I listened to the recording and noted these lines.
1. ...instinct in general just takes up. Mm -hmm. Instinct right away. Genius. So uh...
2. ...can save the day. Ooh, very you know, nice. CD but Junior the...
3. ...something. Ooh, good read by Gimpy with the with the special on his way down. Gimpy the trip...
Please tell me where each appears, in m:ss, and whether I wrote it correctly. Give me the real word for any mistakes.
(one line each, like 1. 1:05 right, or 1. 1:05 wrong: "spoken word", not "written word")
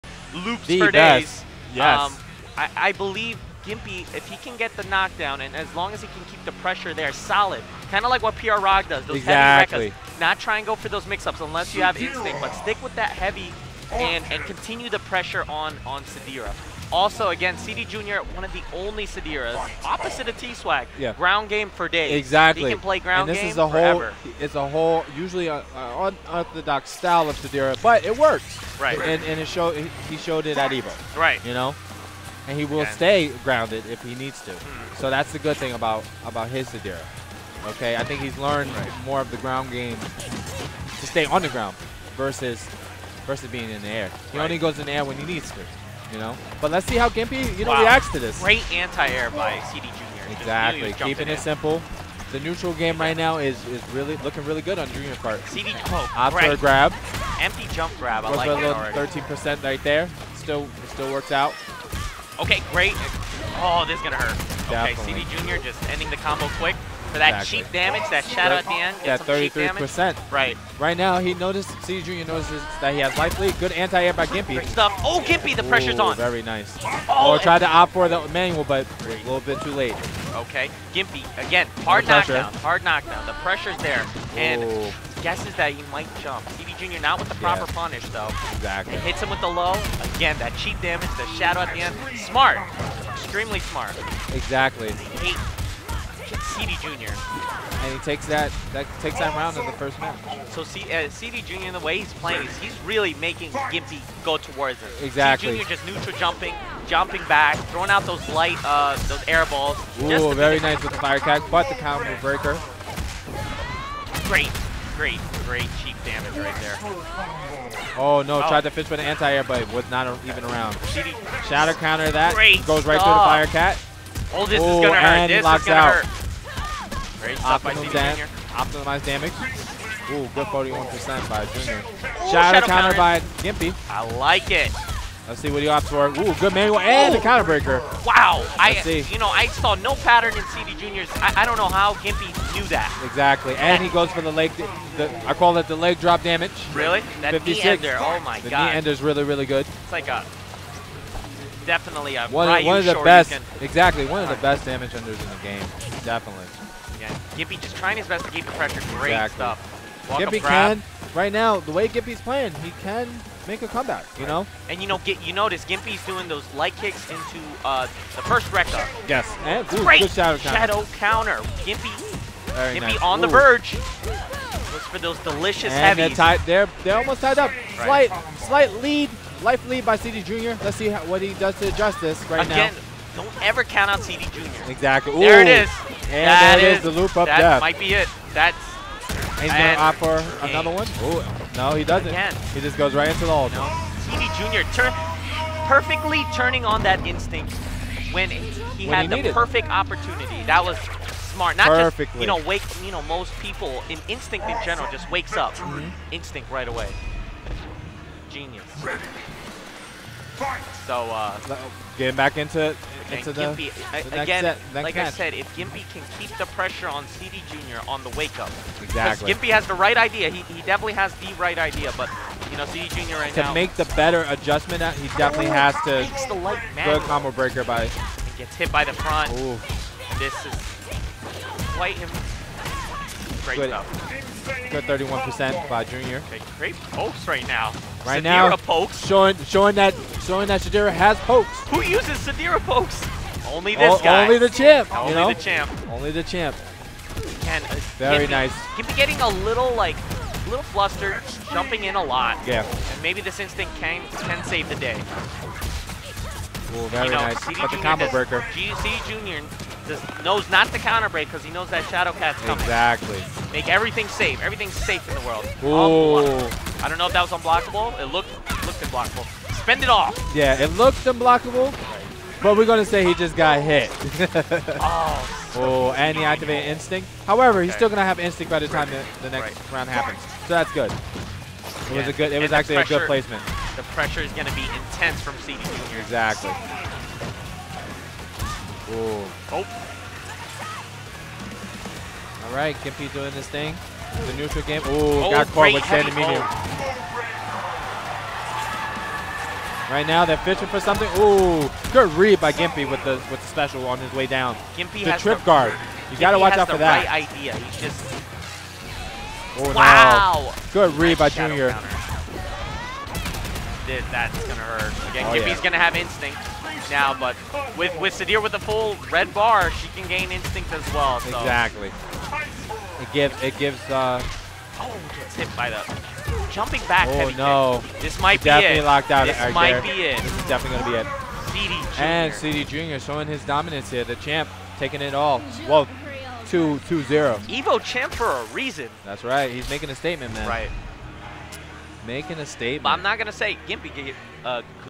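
1. 3:24 wrong: "wakes", not "takes"
2. 4:14 right
3. 5:00 right.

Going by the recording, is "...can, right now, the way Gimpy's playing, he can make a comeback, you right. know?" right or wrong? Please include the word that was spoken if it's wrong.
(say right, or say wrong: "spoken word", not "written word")
right.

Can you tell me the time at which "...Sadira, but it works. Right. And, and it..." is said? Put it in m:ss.
0:27.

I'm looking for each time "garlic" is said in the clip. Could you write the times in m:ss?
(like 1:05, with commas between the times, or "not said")
not said.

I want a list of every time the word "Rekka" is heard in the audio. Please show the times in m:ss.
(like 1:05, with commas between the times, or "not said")
2:48.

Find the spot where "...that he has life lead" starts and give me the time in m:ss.
1:12.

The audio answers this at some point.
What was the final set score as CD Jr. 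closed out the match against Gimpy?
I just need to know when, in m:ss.
5:36.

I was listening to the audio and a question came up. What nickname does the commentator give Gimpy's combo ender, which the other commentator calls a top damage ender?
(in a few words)
leg drop damage.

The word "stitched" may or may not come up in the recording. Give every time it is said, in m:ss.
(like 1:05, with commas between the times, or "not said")
not said.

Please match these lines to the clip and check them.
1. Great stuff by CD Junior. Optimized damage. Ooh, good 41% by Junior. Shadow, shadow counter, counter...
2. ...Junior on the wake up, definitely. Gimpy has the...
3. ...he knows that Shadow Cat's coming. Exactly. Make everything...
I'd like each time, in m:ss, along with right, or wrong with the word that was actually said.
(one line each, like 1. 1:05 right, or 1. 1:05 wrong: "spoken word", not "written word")
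1. 2:07 right
2. 3:37 wrong: "exactly", not "definitely"
3. 4:21 right.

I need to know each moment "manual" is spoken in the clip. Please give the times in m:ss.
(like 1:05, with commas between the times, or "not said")
1:18, 2:16.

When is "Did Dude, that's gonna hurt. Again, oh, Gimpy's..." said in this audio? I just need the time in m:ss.
5:13.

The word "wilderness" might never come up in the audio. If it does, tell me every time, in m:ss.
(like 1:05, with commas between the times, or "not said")
not said.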